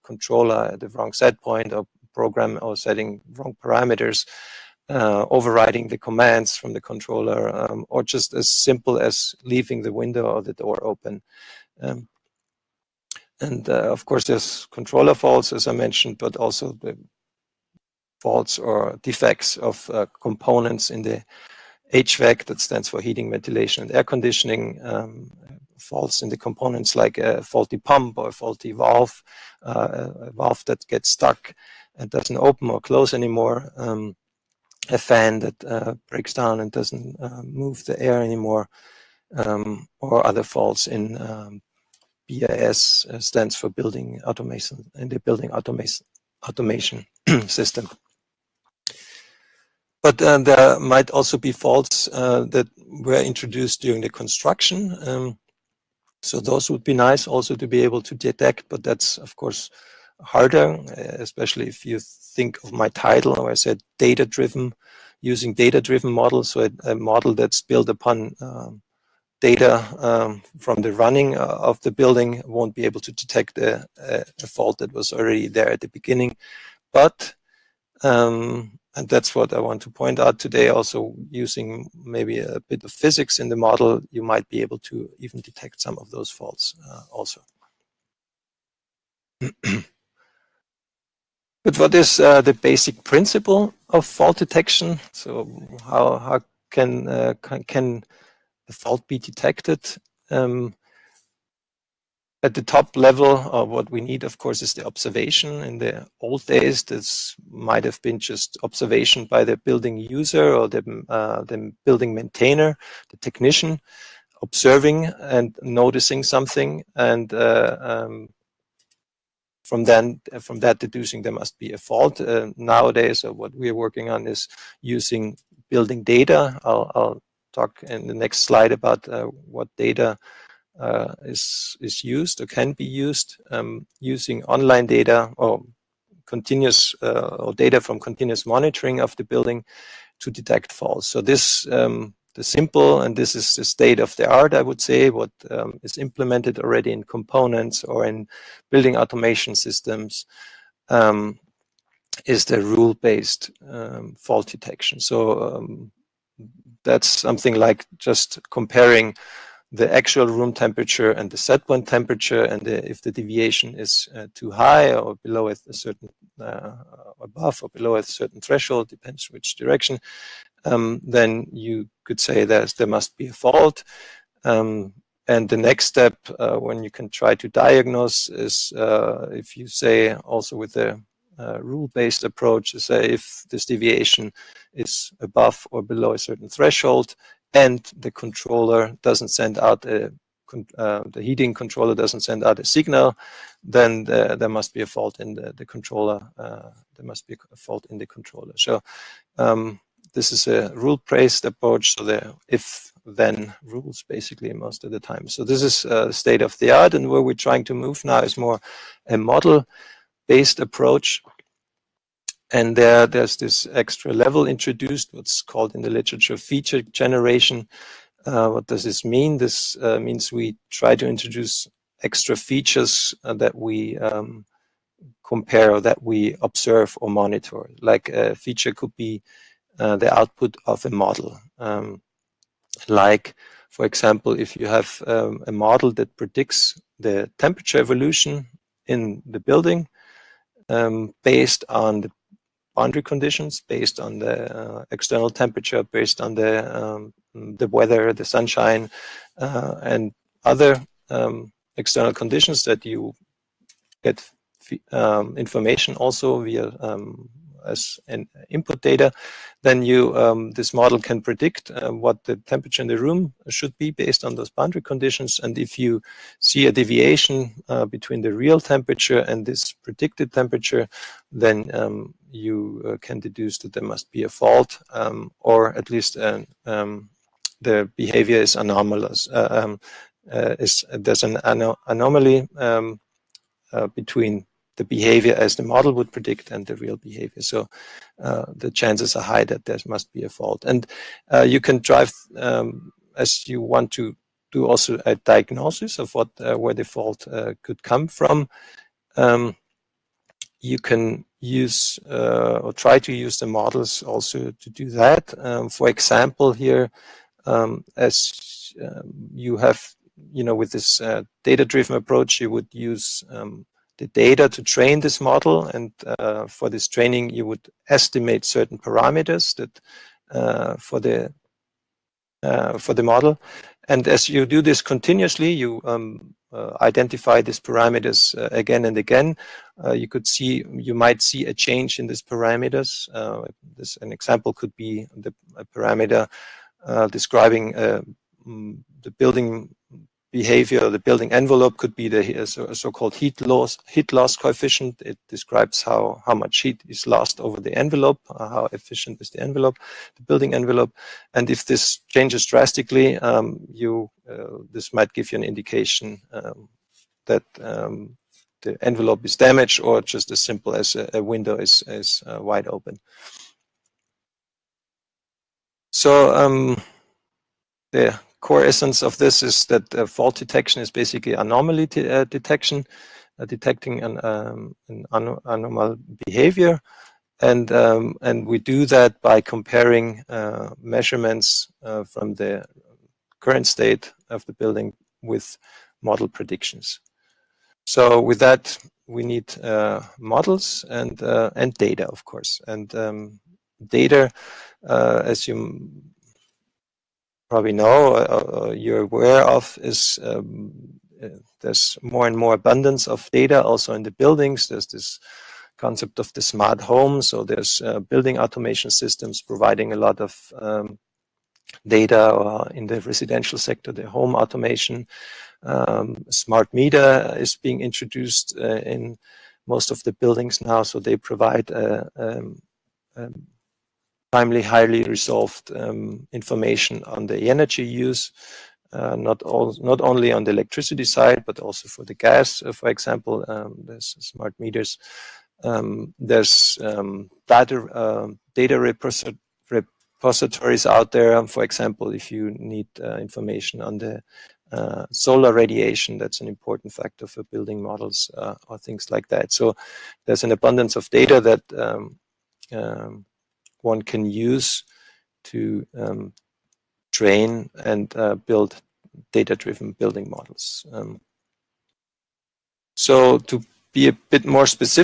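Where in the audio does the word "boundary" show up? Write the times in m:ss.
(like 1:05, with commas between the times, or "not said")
4:02, 4:24.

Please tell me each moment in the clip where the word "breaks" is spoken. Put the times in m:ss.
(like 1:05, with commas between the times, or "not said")
0:36.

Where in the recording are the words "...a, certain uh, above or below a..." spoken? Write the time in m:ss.
2:45.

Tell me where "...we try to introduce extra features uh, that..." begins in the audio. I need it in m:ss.
3:40.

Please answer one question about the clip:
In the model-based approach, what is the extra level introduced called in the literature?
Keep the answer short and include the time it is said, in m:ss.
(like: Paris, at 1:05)
feature generation, at 3:36.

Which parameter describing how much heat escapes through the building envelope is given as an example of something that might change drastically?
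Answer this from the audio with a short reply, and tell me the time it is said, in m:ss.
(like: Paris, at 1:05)
heat loss coefficient, at 5:43.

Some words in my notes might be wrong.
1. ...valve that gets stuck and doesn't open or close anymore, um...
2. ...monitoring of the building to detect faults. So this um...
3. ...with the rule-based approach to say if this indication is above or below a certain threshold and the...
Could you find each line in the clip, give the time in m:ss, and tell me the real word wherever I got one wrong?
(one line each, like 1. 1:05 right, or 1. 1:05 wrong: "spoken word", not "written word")
1. 0:30 right
2. 2:18 right
3. 3:00 wrong: "deviation", not "indication".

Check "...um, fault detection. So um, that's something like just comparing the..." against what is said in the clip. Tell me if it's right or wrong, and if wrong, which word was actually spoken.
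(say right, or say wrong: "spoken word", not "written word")
right.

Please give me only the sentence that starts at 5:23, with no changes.
And as you do this continuously, you um, uh, identify these parameters uh, again and again.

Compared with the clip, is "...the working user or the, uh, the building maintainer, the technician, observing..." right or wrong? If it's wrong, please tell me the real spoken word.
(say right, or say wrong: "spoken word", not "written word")
wrong: "building", not "working".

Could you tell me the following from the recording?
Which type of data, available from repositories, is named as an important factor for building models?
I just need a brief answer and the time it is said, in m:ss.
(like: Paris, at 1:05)
solar radiation, at 7:25.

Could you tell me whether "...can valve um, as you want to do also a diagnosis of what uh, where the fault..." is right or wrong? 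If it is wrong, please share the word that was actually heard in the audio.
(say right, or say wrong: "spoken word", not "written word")
wrong: "drive", not "valve".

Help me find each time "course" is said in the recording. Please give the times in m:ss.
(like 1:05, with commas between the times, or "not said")
0:14, 0:59, 1:44, 6:32.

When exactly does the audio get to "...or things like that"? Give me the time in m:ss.
7:28.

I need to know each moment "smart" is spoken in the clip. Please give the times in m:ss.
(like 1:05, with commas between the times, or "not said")
6:46, 6:56, 7:14.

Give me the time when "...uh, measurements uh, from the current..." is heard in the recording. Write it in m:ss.
6:20.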